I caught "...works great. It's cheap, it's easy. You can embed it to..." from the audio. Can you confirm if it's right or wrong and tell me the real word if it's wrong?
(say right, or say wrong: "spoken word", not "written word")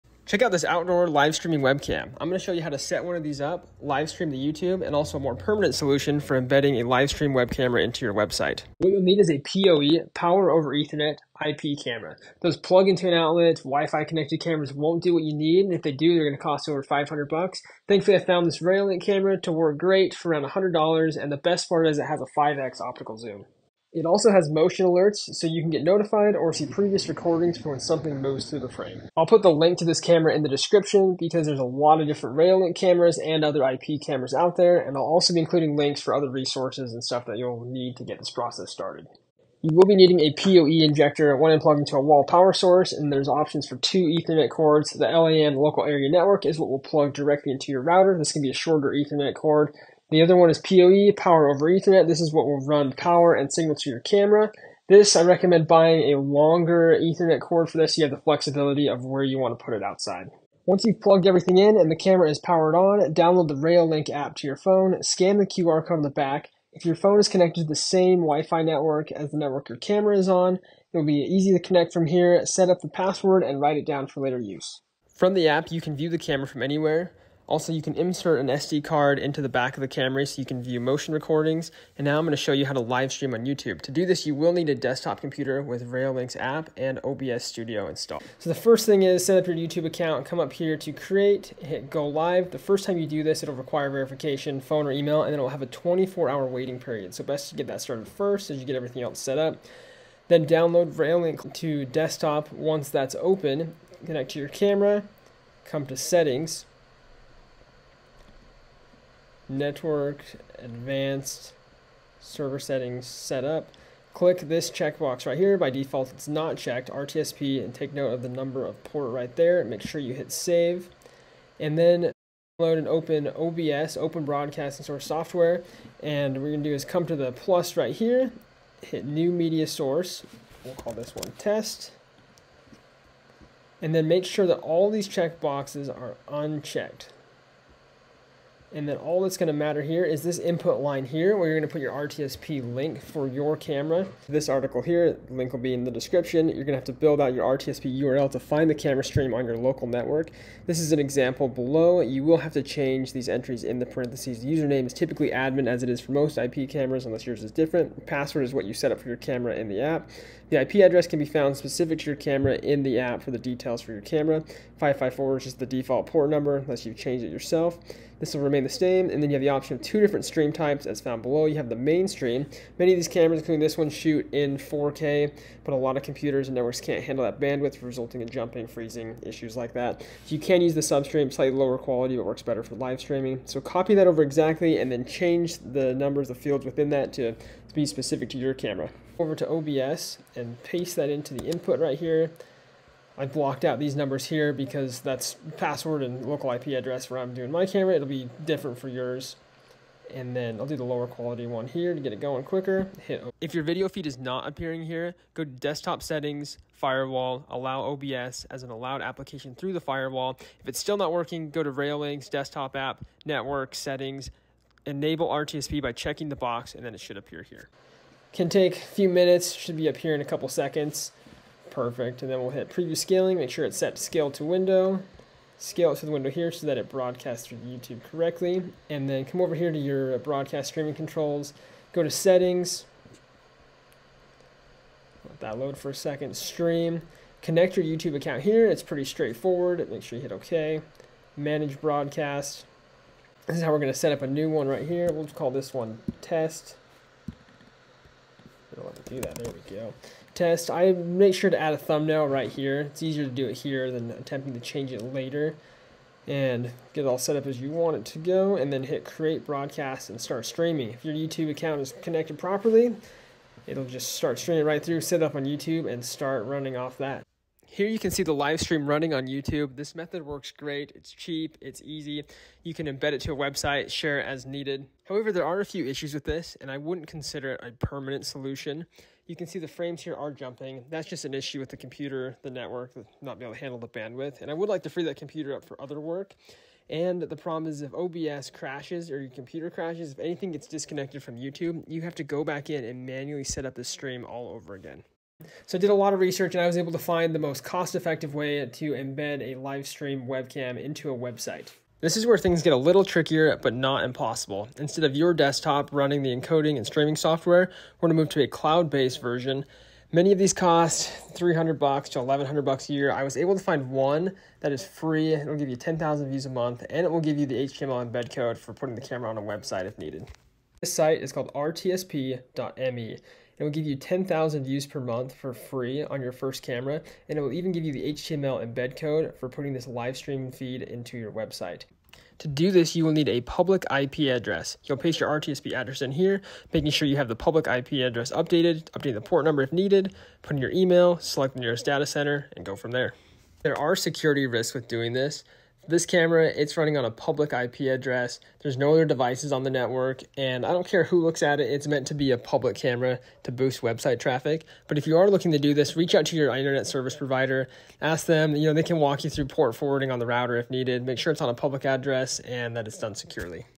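right.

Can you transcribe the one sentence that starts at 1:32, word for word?
The first time you do this, it'll require verification, phone or email, and then it'll have a 24 hour waiting period.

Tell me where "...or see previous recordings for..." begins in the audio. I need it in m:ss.
0:26.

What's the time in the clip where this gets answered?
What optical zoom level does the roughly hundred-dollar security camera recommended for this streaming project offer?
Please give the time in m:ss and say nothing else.
0:22.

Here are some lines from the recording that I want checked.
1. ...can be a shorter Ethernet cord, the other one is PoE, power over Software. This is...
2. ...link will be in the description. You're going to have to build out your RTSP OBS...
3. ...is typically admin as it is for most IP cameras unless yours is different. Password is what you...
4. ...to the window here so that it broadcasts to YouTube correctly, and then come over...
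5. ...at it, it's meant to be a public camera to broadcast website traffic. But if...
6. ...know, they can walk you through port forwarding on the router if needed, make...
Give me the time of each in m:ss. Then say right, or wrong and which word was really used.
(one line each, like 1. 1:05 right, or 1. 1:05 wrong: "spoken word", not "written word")
1. 0:48 wrong: "Ethernet", not "Software"
2. 2:25 wrong: "URL", not "OBS"
3. 2:34 right
4. 3:45 right
5. 5:51 wrong: "boost", not "broadcast"
6. 5:58 right.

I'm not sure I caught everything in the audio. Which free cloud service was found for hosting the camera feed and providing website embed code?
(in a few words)
rtsp.me.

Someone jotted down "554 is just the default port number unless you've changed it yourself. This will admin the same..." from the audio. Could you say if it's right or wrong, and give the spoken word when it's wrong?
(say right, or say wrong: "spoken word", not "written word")
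wrong: "remain", not "admin".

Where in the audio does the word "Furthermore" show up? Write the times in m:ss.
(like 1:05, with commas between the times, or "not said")
not said.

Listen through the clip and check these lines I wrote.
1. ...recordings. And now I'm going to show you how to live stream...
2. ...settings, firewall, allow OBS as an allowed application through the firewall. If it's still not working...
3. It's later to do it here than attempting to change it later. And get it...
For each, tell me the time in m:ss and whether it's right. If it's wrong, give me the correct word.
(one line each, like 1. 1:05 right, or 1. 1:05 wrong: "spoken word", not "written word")
1. 1:21 right
2. 3:26 right
3. 4:12 wrong: "easier", not "later".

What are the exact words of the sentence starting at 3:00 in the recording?
you can use the substream, slightly lower quality, but works better for live streaming.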